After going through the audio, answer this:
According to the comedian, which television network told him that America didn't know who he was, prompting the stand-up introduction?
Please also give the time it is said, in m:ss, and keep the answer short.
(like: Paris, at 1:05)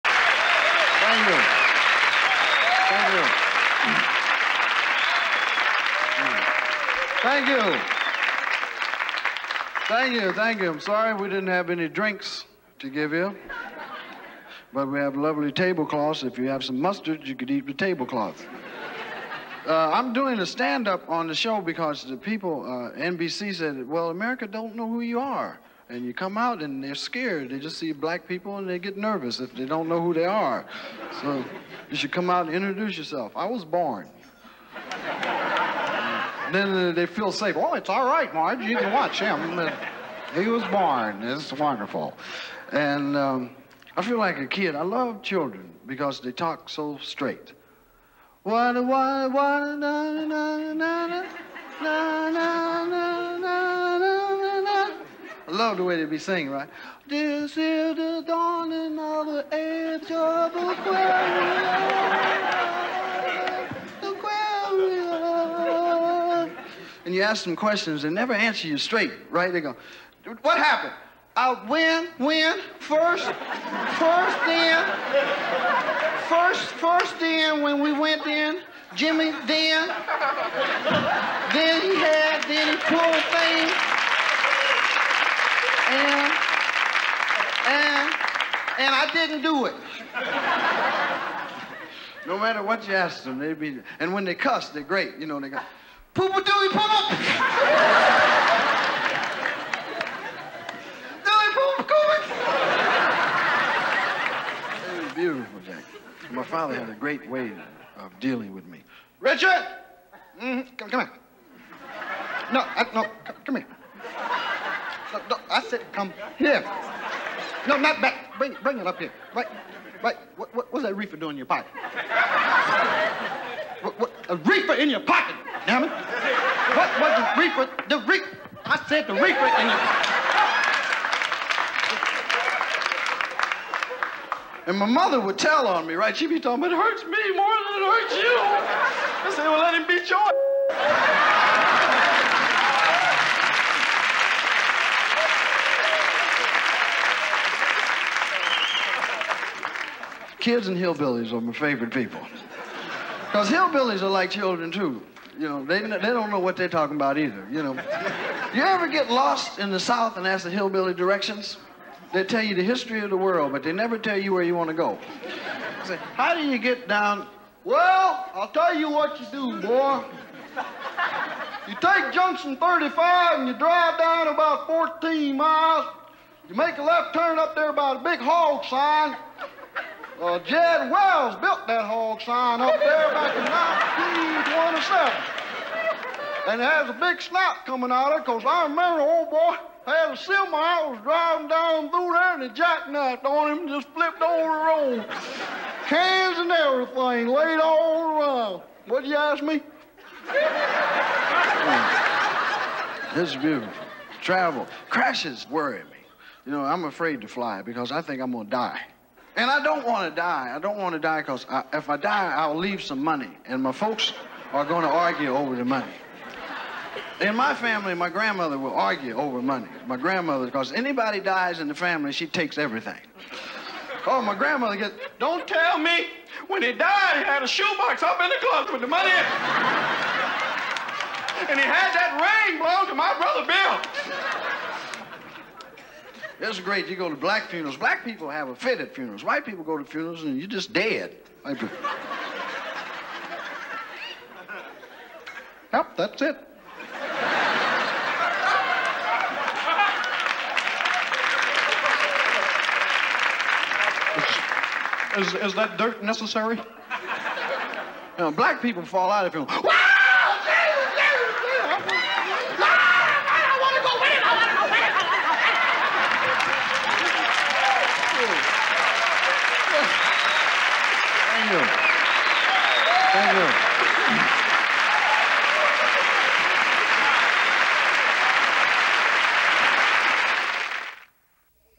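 NBC, at 0:22.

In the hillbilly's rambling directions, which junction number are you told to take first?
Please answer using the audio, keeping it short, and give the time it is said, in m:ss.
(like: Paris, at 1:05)
Junction 35, at 2:52.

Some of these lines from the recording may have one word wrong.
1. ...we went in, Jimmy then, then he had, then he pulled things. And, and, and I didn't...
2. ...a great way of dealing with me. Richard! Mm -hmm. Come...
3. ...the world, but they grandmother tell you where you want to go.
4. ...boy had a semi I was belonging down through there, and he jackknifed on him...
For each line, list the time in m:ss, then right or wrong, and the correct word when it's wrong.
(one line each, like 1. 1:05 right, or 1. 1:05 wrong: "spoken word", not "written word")
1. 1:17 right
2. 1:46 right
3. 2:43 wrong: "never", not "grandmother"
4. 3:09 wrong: "driving", not "belonging".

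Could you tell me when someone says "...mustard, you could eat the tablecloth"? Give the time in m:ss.
0:16.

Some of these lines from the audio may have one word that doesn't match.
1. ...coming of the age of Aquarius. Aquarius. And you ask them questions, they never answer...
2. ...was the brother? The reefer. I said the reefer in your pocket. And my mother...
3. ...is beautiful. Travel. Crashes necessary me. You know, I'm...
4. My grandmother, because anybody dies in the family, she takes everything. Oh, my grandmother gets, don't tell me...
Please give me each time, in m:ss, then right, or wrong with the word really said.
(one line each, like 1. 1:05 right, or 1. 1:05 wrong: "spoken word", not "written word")
1. 0:58 wrong: "dawning", not "coming"
2. 2:07 wrong: "reefer", not "brother"
3. 3:23 wrong: "worry", not "necessary"
4. 3:39 right.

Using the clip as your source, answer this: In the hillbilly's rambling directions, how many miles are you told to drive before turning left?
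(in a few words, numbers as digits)
14 miles.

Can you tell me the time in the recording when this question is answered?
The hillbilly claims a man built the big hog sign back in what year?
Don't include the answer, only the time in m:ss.
3:04.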